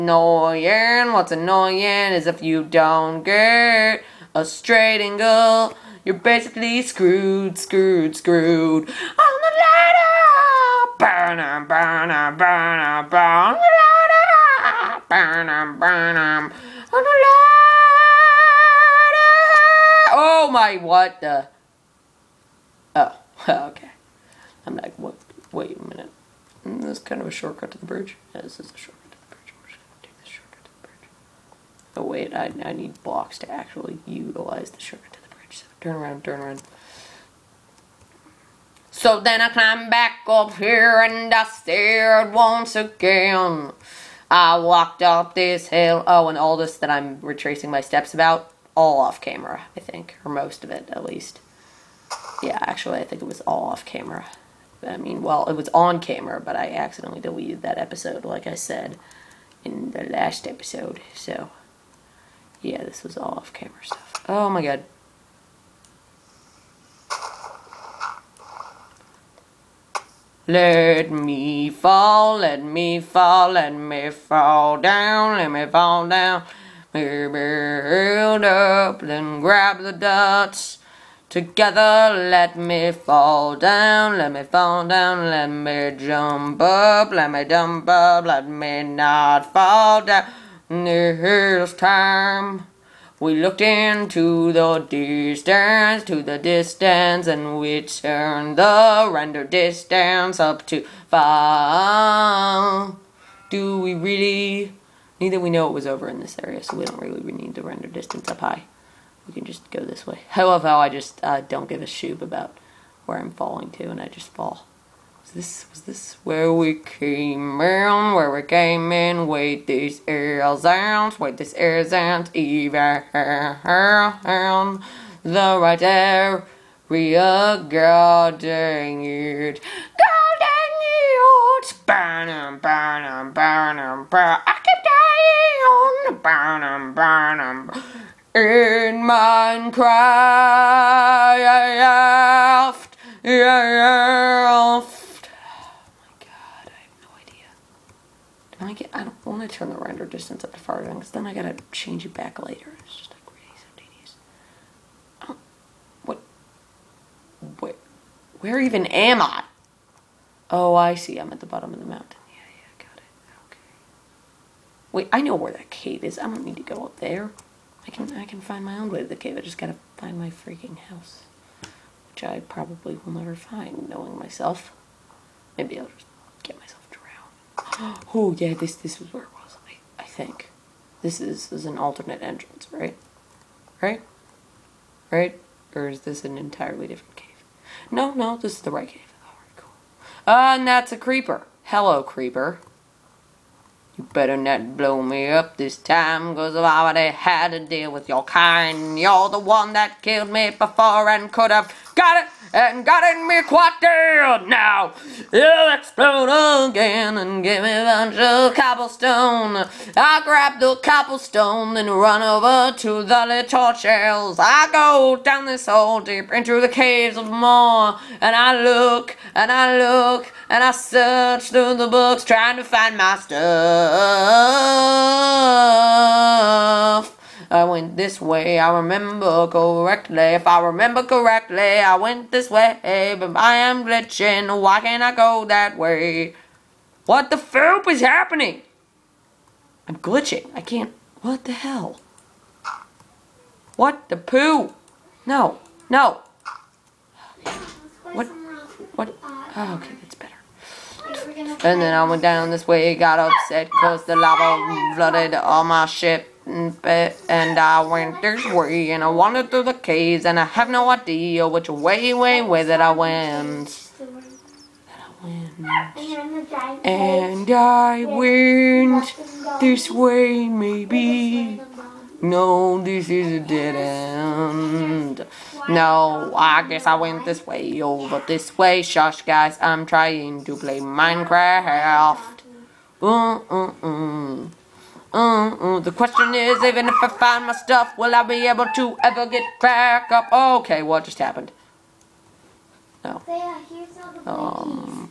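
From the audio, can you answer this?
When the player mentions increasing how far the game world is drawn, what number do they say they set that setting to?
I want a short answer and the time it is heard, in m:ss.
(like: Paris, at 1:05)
5, at 1:41.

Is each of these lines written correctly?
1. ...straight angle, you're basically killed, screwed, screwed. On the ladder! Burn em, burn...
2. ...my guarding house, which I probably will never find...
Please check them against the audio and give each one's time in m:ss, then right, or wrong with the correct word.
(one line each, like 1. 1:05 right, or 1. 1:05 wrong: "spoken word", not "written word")
1. 0:04 wrong: "screwed", not "killed"
2. 2:50 wrong: "freaking", not "guarding".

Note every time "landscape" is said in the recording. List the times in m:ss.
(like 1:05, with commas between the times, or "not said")
not said.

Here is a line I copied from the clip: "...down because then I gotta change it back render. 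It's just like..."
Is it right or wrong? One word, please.
wrong.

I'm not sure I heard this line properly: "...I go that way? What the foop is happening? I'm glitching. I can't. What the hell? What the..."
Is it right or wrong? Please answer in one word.
right.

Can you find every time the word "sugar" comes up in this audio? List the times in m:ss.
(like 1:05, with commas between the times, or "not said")
0:34.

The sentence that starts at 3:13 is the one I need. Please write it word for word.
You better not blow me up this time, cause I've already had to deal with your kind.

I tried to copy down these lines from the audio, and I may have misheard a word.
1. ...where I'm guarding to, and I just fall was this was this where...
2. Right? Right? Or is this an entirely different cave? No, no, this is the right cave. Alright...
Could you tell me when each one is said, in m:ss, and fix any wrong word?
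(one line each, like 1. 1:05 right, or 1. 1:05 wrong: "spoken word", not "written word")
1. 1:53 wrong: "falling", not "guarding"
2. 3:03 right.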